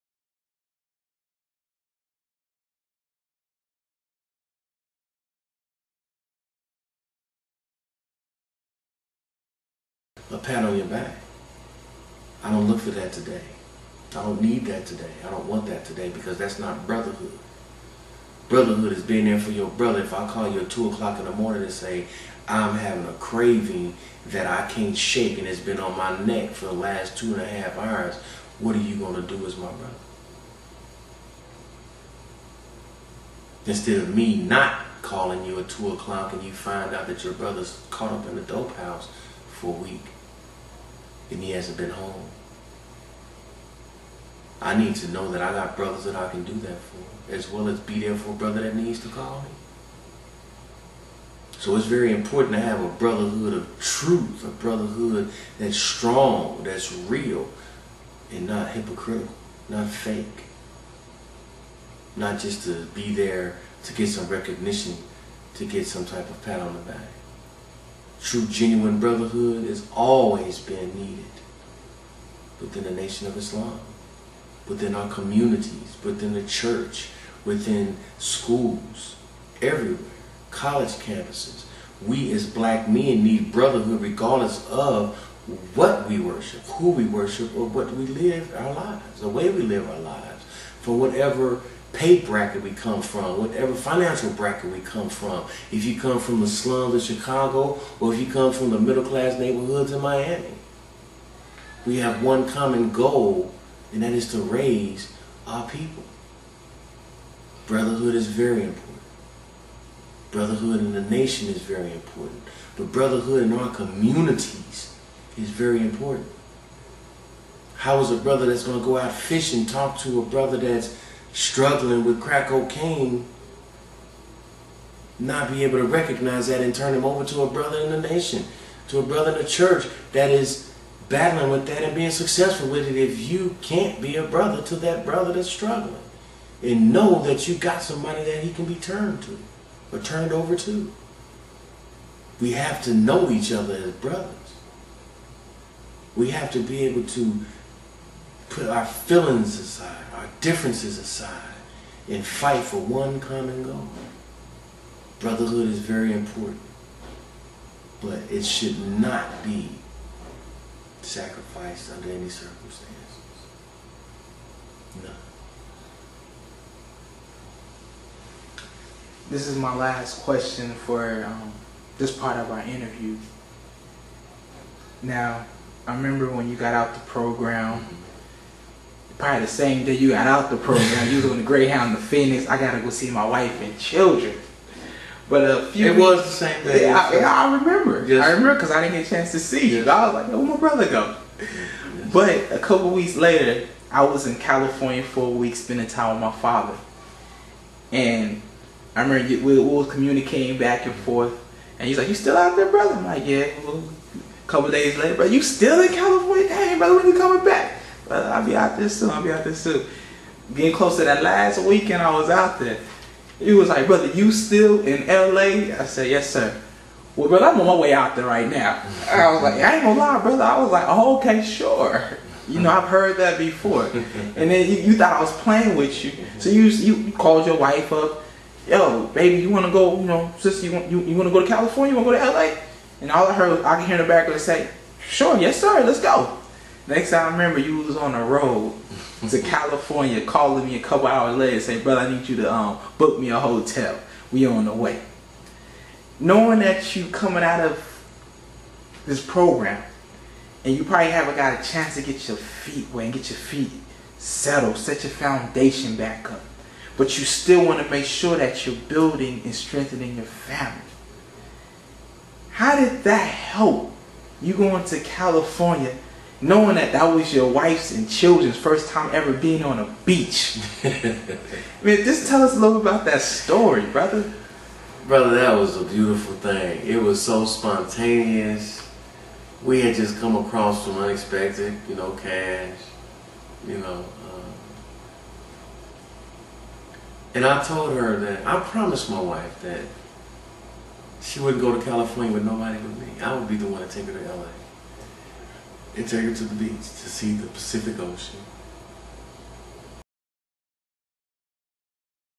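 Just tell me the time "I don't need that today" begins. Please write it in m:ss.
0:14.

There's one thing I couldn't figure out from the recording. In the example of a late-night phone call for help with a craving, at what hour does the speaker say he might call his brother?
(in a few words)
2 o'clock in the morning.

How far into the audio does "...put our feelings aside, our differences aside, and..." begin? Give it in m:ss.
2:28.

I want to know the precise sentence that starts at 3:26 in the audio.
Hey, brother, when you coming back?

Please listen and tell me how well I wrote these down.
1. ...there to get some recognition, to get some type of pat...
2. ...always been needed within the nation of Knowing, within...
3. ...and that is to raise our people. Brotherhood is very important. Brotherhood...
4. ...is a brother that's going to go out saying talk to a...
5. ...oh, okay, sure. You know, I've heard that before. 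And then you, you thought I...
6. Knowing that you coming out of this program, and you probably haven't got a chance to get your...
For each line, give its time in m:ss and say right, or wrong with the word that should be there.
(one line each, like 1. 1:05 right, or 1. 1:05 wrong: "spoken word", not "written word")
1. 1:03 right
2. 1:09 wrong: "Islam", not "Knowing"
3. 1:43 right
4. 1:57 wrong: "fishing", not "saying"
5. 3:40 right
6. 4:06 right.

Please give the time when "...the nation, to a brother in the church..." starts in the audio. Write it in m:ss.
2:07.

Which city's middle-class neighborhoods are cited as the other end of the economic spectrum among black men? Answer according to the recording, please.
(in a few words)
Miami.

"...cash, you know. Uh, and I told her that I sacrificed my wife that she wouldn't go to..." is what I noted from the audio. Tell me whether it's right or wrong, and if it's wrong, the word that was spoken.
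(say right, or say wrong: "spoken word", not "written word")
wrong: "promised", not "sacrificed".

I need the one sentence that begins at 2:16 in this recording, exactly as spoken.
And know that you got somebody that he can be turned to or turned over to.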